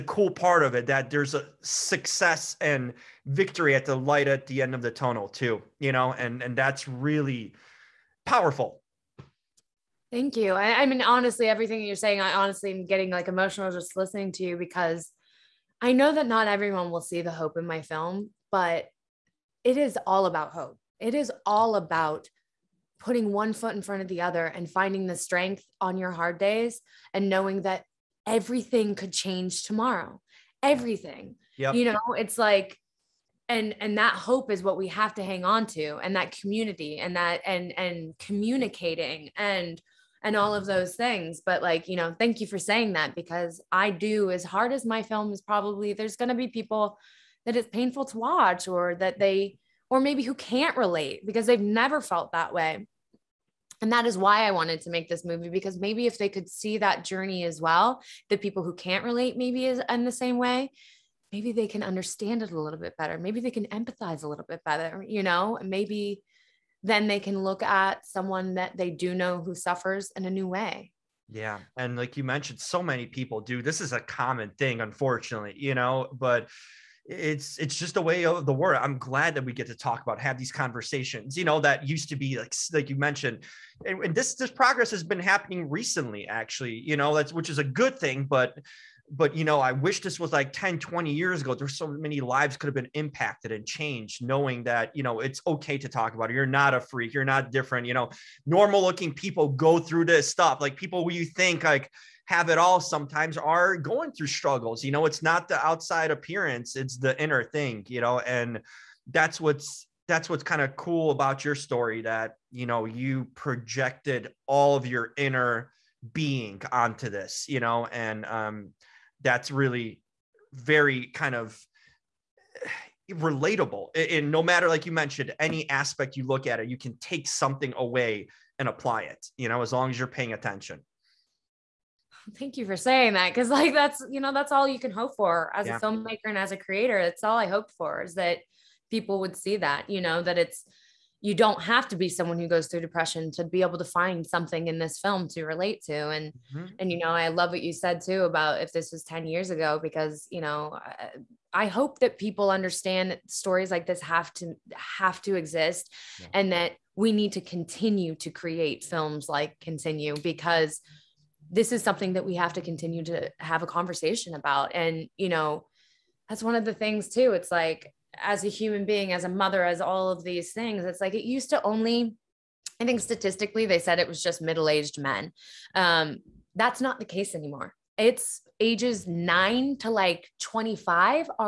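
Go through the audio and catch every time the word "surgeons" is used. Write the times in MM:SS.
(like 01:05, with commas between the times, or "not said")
not said.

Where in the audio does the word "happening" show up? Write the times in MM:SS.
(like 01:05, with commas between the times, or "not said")
01:25.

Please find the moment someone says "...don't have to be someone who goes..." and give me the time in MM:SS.
02:21.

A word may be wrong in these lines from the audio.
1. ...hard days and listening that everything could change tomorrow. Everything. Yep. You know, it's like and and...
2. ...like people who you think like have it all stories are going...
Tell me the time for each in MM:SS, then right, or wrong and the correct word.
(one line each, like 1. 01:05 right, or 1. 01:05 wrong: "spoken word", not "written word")
1. 00:26 wrong: "knowing", not "listening"
2. 01:40 wrong: "sometimes", not "stories".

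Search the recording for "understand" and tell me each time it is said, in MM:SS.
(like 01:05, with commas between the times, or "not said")
01:01, 02:32.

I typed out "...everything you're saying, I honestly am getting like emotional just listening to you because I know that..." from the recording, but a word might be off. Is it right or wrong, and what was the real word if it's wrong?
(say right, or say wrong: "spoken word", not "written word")
right.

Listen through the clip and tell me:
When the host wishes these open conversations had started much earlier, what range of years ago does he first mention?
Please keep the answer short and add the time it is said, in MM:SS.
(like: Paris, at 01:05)
10 to 20 years, at 01:30.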